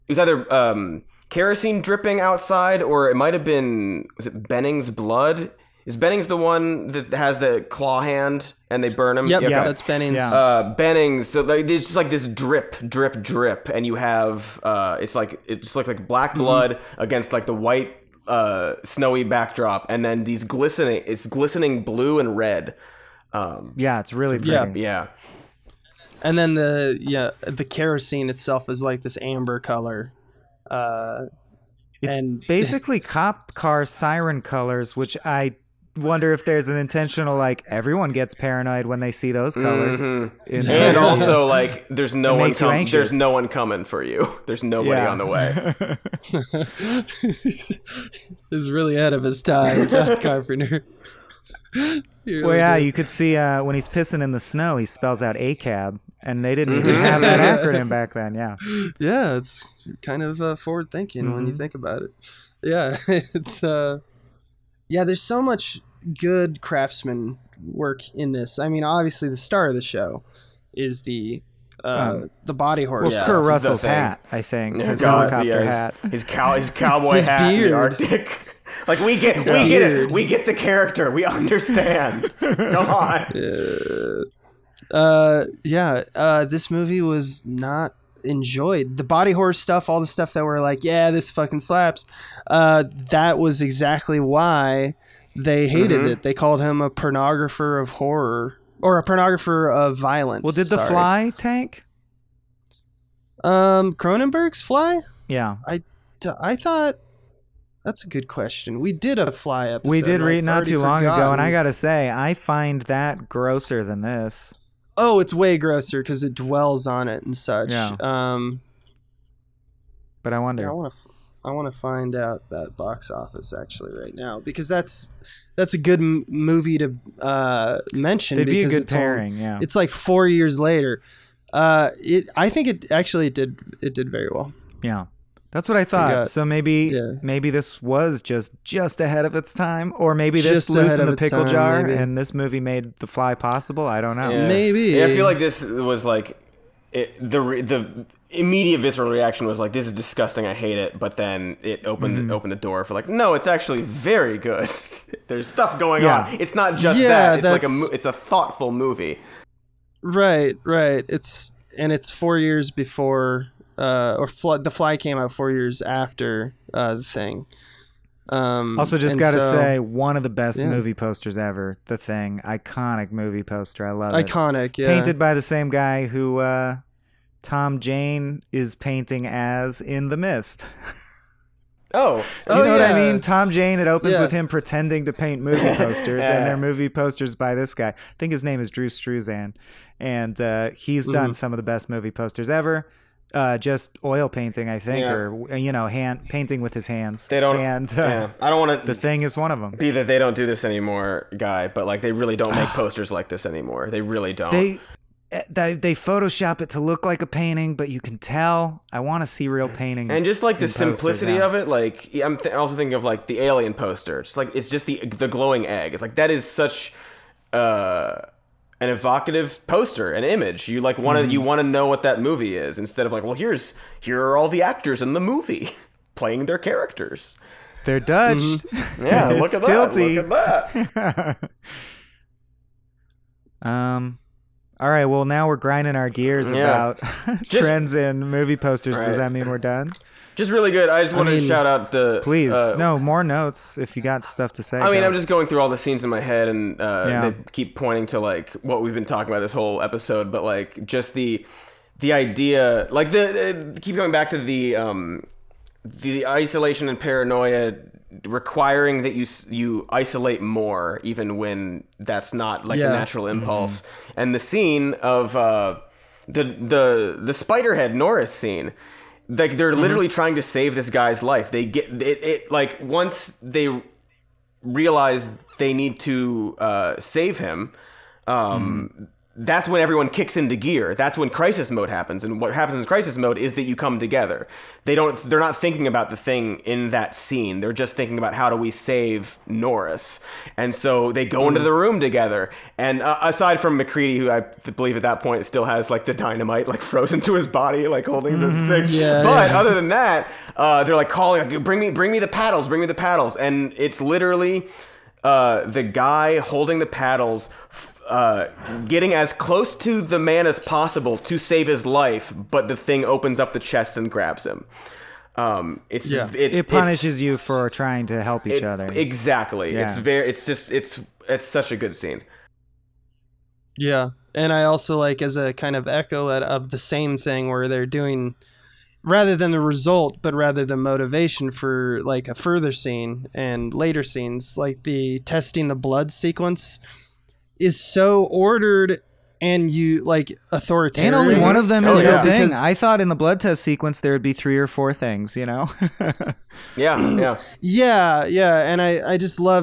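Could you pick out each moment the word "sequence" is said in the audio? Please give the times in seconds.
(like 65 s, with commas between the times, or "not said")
336 s, 343 s.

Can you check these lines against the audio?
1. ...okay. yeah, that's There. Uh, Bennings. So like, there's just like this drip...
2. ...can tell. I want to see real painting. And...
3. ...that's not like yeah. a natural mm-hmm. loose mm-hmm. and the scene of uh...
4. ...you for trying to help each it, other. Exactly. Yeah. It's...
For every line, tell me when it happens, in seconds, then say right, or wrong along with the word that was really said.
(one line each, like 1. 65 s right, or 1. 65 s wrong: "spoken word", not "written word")
1. 9 s wrong: "Bennings", not "There"
2. 208 s right
3. 261 s wrong: "impulse", not "loose"
4. 317 s right.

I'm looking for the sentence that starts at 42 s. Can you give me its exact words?
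there's no one coming for you.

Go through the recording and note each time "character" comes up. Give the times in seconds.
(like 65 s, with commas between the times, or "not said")
80 s, 226 s.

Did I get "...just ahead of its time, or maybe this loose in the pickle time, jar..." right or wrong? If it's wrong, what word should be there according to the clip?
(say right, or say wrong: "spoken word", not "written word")
right.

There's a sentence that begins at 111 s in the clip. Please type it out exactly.
ago, and I gotta say, I find that grosser than this.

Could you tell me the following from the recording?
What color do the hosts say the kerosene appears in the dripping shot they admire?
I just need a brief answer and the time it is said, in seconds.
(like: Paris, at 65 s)
amber, at 29 s.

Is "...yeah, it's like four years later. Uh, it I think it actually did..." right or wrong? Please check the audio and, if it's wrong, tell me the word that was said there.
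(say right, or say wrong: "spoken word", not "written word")
right.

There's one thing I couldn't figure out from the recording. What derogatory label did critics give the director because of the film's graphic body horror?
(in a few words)
pornographer of horror.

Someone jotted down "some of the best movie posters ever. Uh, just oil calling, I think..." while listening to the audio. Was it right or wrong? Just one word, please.
wrong.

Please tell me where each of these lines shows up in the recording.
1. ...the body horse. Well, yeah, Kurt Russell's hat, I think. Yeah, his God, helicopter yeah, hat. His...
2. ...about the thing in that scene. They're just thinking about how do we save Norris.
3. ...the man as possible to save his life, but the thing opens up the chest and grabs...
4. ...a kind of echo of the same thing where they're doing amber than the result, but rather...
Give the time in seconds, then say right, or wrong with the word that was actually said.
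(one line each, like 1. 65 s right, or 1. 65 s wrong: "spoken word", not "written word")
1. 72 s right
2. 285 s right
3. 310 s right
4. 325 s wrong: "rather", not "amber".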